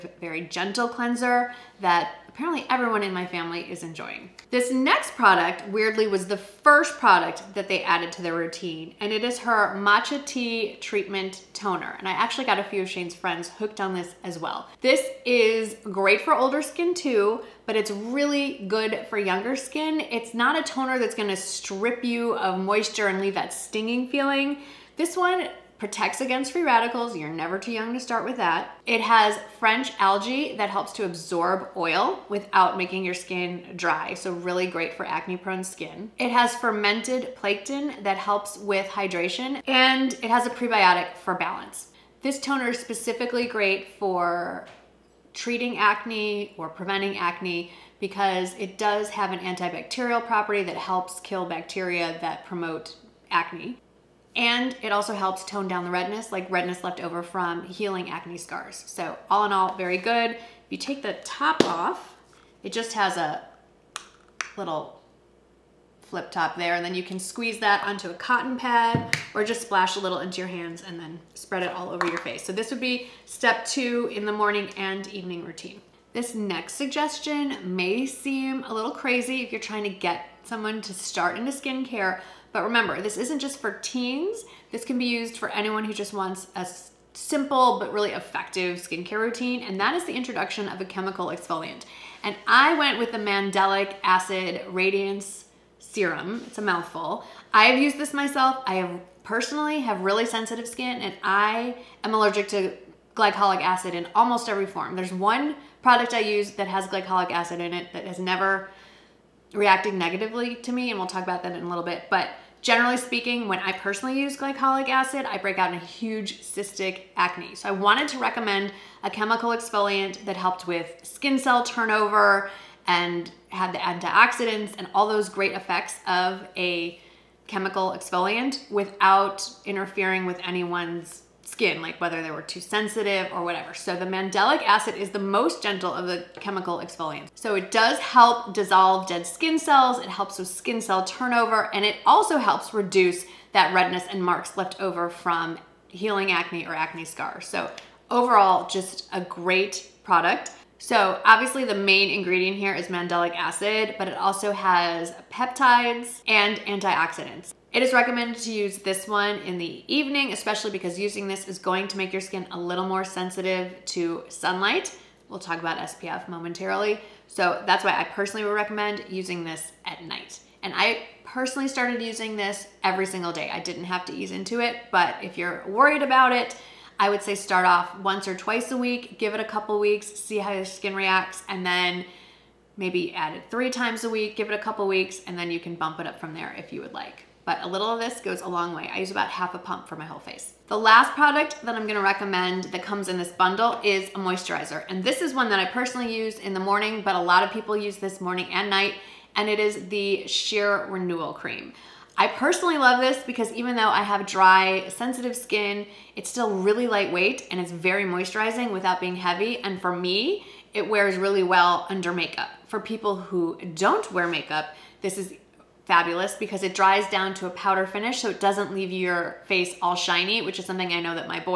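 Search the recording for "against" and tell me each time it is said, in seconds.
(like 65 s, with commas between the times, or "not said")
26 s.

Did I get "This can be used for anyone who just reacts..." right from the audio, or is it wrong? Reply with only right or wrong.
wrong.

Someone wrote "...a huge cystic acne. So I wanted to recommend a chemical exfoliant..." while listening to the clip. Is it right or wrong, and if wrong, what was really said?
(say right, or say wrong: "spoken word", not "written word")
right.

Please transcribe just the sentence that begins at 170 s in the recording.
And I personally started using this every single day.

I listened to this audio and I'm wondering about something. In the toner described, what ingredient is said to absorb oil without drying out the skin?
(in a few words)
French algae.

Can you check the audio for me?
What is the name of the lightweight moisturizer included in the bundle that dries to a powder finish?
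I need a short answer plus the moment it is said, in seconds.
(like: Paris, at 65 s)
Sheer Renewal Cream, at 200 s.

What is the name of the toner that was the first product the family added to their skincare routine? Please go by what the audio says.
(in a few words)
Matcha Tea Treatment Toner.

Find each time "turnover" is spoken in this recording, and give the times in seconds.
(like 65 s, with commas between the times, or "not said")
121 s, 141 s.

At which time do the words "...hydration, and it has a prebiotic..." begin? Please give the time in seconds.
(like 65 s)
38 s.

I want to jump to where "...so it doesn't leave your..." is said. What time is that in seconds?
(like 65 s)
218 s.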